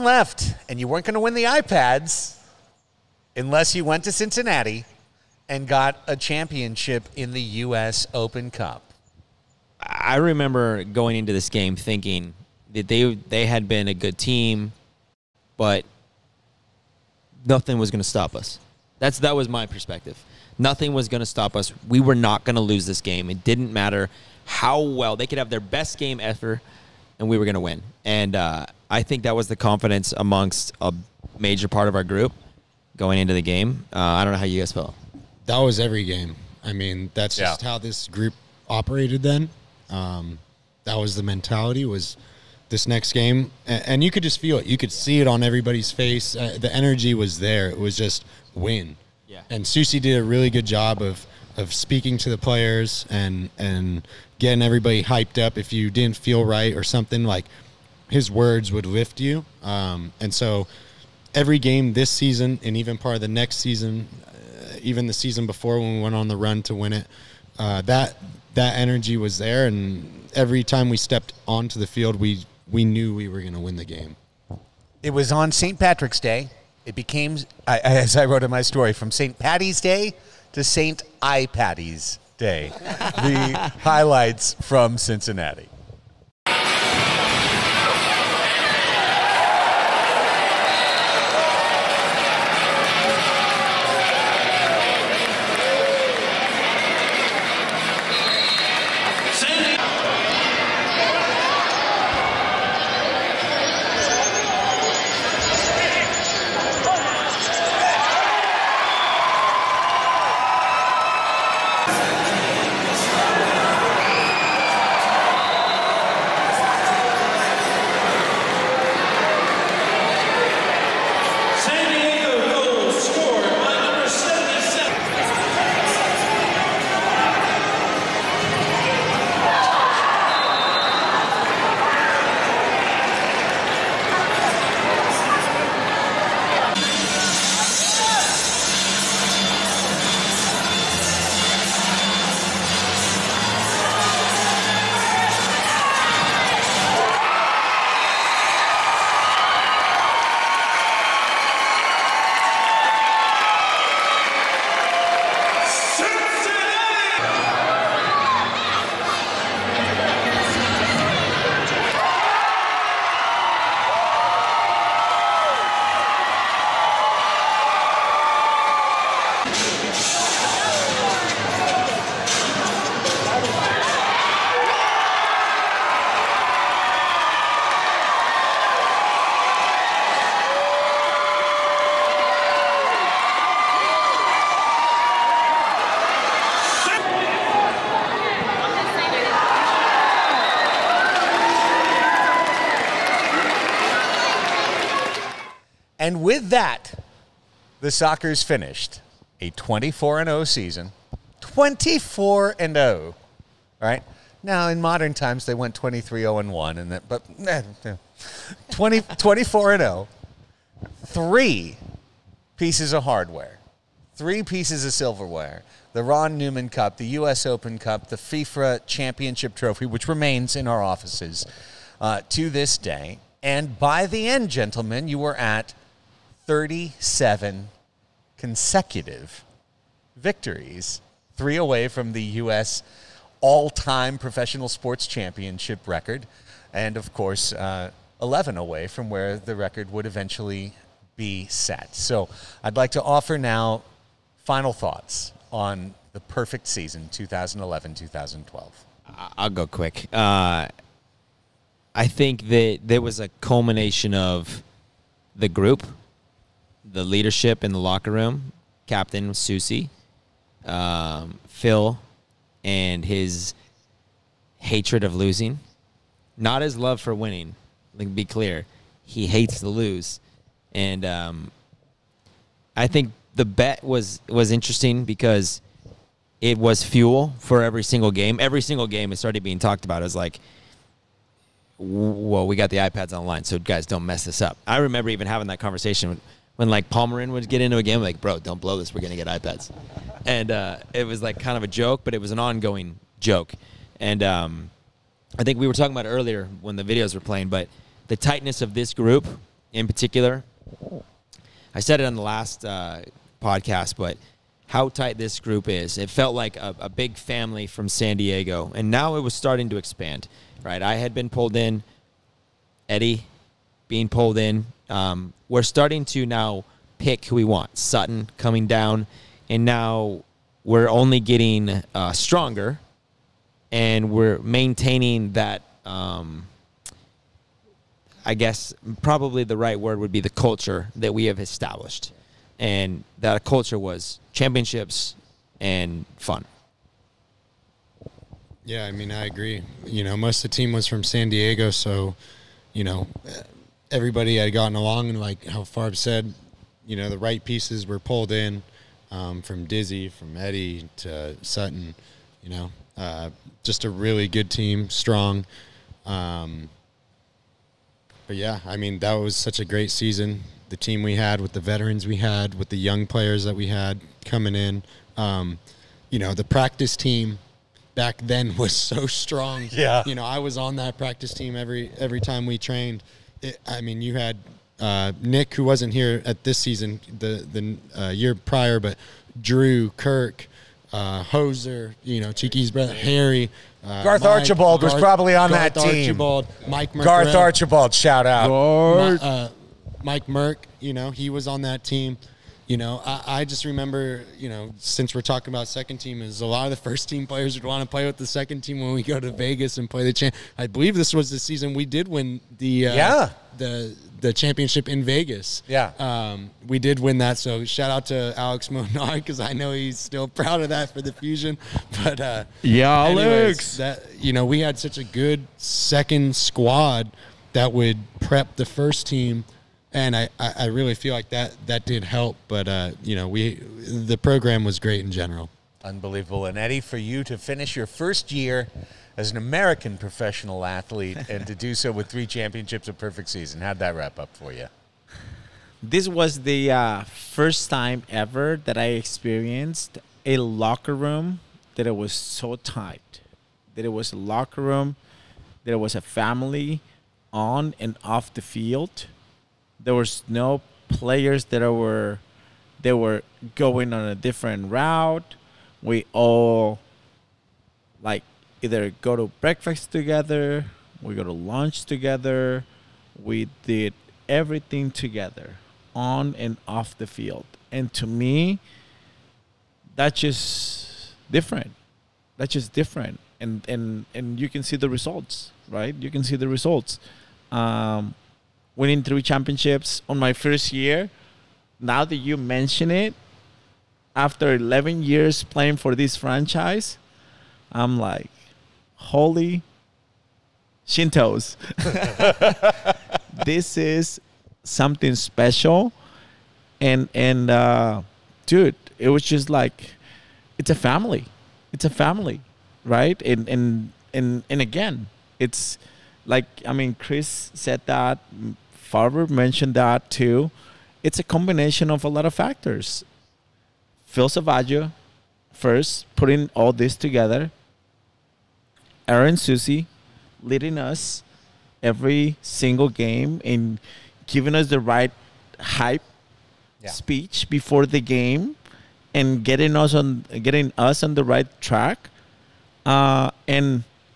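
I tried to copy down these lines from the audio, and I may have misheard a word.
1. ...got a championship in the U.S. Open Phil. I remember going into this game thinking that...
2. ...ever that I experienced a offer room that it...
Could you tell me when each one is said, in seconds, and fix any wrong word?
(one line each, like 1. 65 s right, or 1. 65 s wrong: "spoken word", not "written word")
1. 5 s wrong: "Cup", not "Phil"
2. 438 s wrong: "locker", not "offer".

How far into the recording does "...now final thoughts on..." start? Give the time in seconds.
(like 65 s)
243 s.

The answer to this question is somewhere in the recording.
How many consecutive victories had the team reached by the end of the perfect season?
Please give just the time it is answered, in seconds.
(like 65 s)
226 s.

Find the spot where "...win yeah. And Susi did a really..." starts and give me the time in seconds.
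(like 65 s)
48 s.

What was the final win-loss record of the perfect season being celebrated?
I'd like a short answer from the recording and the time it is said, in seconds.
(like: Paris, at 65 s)
24-0, at 199 s.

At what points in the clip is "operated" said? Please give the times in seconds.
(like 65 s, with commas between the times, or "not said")
38 s.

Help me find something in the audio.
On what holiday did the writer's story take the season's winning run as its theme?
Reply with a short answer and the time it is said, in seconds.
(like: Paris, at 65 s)
St. Patrick's Day, at 75 s.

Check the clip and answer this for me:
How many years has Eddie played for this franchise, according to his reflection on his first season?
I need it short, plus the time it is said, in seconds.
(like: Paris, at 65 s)
11, at 484 s.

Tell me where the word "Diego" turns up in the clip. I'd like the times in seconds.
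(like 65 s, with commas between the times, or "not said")
308 s, 341 s.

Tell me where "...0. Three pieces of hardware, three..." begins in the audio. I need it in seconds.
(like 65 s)
209 s.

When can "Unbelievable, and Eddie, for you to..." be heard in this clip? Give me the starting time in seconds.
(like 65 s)
425 s.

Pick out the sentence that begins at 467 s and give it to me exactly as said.
And to me, that's just different.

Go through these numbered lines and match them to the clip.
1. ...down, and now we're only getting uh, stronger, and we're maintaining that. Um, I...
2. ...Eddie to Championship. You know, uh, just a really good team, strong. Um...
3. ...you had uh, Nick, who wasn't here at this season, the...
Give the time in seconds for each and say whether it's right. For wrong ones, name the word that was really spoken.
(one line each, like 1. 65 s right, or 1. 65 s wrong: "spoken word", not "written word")
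1. 318 s right
2. 350 s wrong: "Sutton", not "Championship"
3. 374 s right.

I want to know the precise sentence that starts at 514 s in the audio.
Phil Salvagio, first, putting all this together.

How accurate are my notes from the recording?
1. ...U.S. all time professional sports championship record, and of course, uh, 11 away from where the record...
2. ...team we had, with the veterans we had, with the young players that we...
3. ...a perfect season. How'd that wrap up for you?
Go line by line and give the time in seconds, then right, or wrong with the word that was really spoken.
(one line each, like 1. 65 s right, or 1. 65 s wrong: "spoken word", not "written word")
1. 232 s right
2. 360 s right
3. 432 s right.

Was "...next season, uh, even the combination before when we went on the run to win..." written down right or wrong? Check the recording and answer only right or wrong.
wrong.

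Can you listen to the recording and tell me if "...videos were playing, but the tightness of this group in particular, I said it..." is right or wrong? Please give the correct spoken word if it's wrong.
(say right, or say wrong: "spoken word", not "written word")
right.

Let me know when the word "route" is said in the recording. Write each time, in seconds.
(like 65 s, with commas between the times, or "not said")
454 s.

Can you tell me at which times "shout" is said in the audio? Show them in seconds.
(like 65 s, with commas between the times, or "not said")
387 s, 407 s.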